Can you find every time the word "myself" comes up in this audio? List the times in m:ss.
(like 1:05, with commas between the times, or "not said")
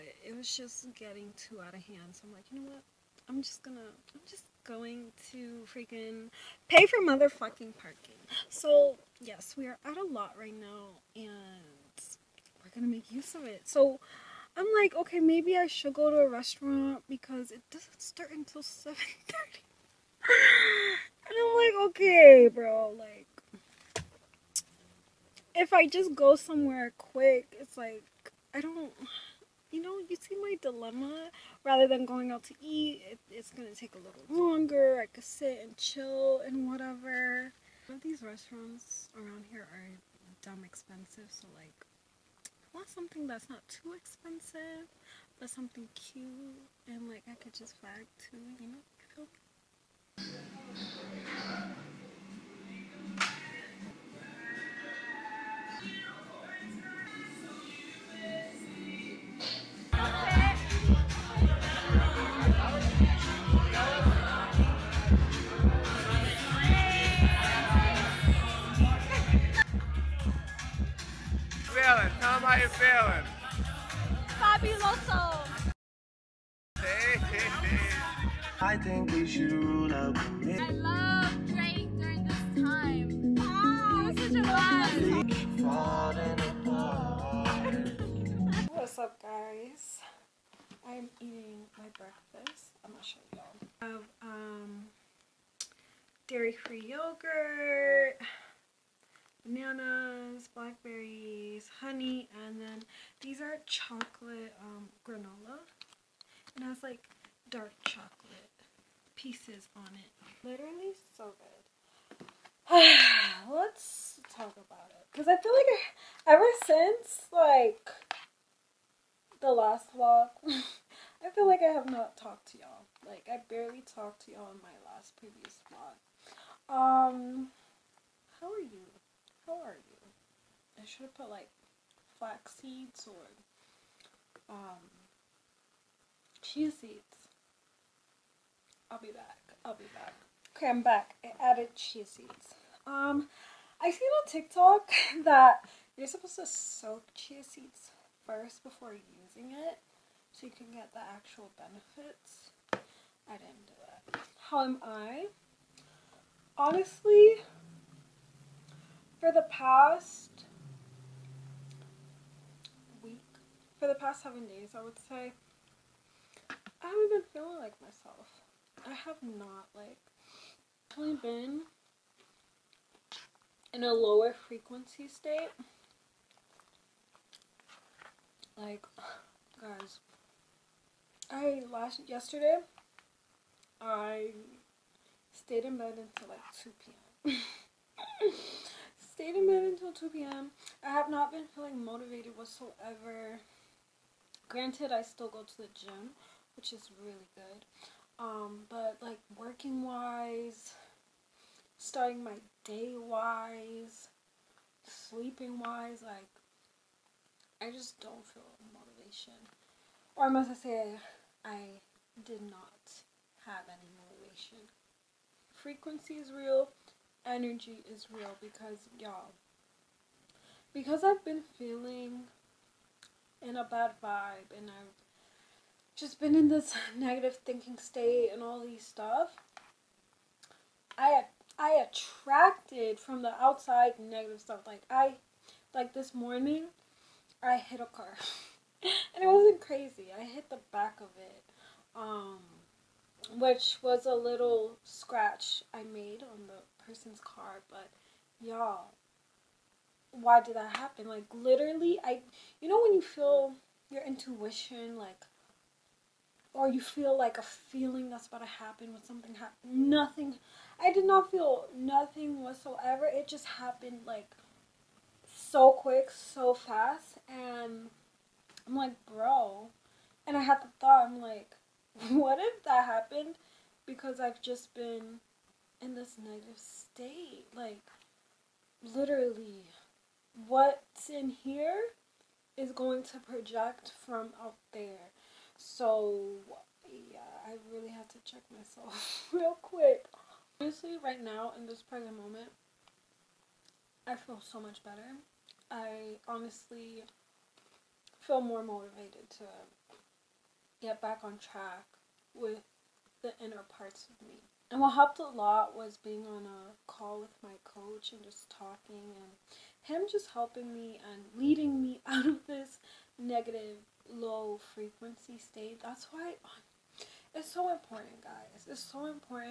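2:47, 4:48.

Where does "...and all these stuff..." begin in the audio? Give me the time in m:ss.
3:48.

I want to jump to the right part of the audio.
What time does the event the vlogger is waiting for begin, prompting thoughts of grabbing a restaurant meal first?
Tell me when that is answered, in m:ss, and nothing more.
0:18.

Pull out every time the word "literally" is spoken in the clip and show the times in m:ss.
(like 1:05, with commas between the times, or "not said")
1:50, 4:11, 4:38.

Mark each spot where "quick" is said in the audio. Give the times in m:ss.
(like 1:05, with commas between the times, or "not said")
0:26, 4:25, 4:49.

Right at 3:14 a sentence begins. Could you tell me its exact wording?
Granted, I still go to the gym, which is really good.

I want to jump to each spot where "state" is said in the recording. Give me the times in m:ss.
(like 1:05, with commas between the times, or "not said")
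2:55, 3:47, 4:36, 5:15.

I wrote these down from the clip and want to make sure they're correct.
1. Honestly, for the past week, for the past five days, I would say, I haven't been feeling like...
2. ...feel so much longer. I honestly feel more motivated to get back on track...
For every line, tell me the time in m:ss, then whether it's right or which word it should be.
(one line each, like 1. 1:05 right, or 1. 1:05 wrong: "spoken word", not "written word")
1. 2:36 wrong: "seven", not "five"
2. 4:54 wrong: "better", not "longer".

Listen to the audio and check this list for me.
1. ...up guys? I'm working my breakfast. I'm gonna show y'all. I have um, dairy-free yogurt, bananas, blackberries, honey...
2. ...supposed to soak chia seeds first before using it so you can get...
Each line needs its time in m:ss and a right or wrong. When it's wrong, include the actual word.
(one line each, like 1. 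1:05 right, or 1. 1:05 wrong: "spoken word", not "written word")
1. 1:29 wrong: "eating", not "working"
2. 2:26 right.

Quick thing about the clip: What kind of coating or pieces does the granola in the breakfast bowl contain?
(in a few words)
Dark chocolate.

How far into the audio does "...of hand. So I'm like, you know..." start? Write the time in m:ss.
0:01.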